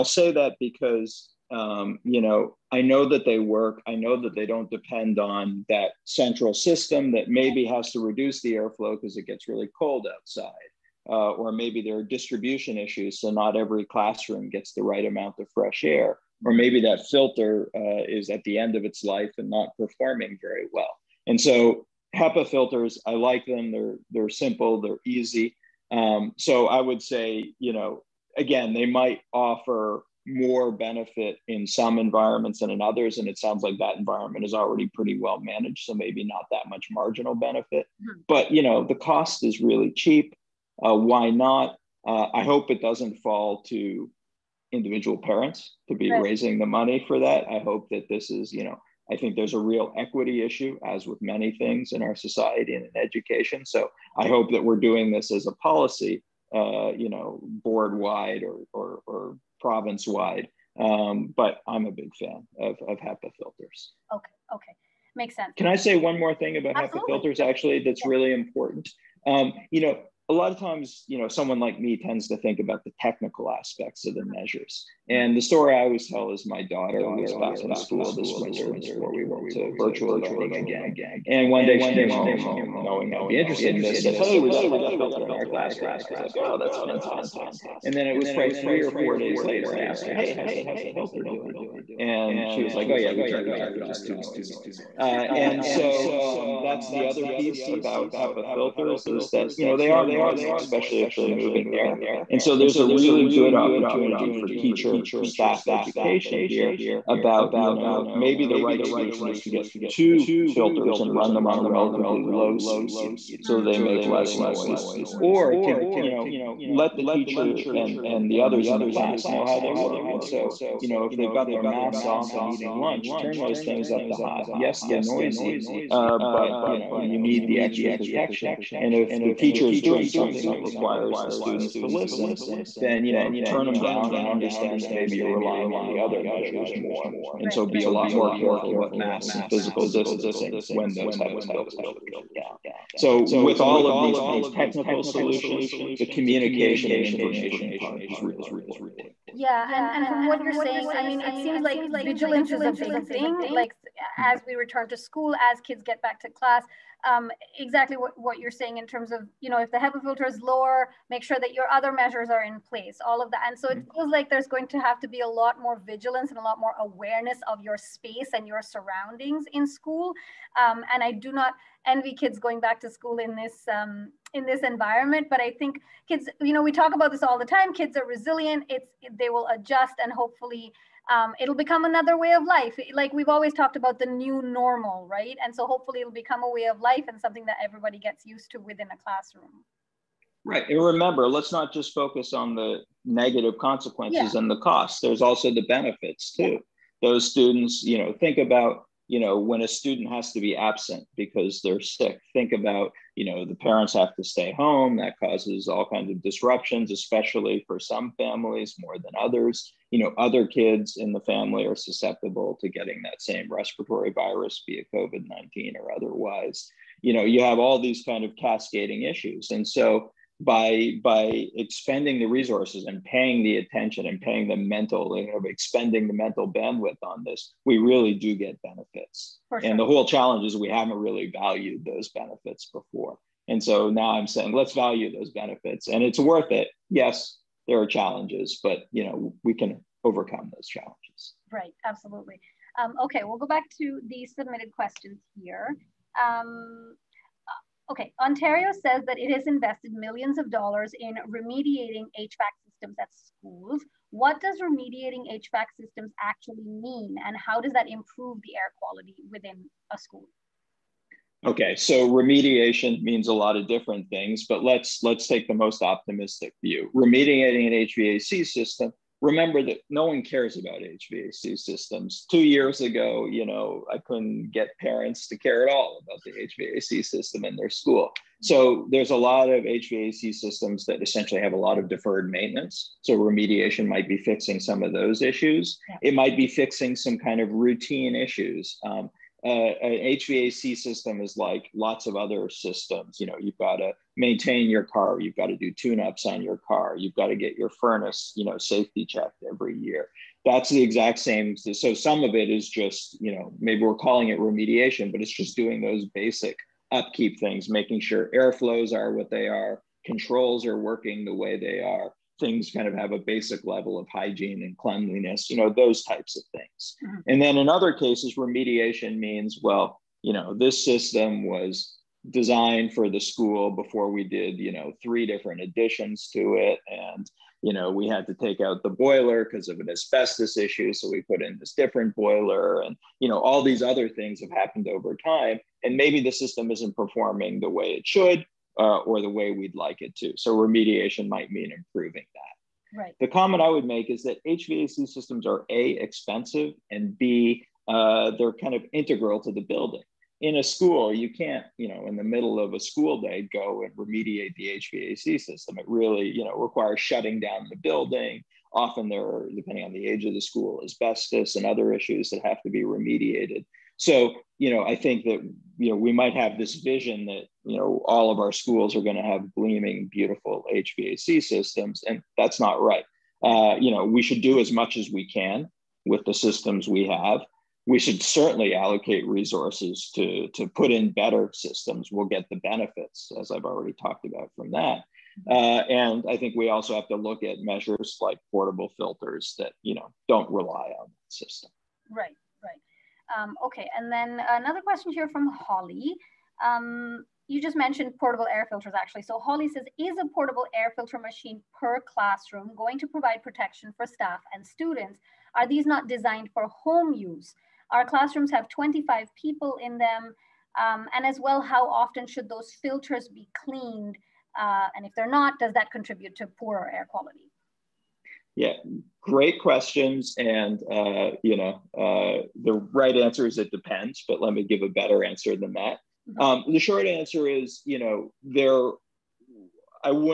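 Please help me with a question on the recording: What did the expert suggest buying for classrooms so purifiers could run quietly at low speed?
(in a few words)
Two filters.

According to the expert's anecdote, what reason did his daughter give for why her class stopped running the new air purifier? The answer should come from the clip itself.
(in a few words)
It was too noisy.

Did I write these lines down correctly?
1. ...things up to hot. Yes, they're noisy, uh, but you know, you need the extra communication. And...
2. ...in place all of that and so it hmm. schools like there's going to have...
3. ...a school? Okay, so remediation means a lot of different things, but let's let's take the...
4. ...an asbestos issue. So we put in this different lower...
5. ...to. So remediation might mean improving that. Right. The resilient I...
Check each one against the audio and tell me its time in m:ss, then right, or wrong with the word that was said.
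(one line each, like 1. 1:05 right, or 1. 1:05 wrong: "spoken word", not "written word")
1. 2:03 wrong: "protection", not "communication"
2. 2:42 wrong: "feels", not "schools"
3. 4:19 right
4. 5:29 wrong: "boiler", not "lower"
5. 5:40 wrong: "comment", not "resilient".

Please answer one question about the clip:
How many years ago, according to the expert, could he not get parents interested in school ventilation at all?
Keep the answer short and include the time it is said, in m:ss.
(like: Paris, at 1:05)
2 years, at 4:32.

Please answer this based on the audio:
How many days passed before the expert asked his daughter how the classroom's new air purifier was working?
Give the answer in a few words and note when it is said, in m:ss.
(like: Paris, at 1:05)
3 or 4 days, at 1:28.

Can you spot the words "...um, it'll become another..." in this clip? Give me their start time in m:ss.
3:01.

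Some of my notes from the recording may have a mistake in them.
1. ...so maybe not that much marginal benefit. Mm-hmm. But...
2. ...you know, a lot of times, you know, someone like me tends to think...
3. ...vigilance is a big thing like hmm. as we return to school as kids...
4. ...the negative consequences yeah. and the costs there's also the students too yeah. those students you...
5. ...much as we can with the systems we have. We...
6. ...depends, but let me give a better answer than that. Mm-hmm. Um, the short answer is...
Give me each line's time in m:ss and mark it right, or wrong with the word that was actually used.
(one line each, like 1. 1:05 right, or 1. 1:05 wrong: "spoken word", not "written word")
1. 0:35 right
2. 1:09 right
3. 2:32 right
4. 3:12 wrong: "benefits", not "students"
5. 6:14 right
6. 7:03 right.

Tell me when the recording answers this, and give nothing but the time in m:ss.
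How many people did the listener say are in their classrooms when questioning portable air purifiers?
6:48.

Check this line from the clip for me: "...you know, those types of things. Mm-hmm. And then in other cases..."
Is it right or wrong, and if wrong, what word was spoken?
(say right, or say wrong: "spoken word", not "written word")
right.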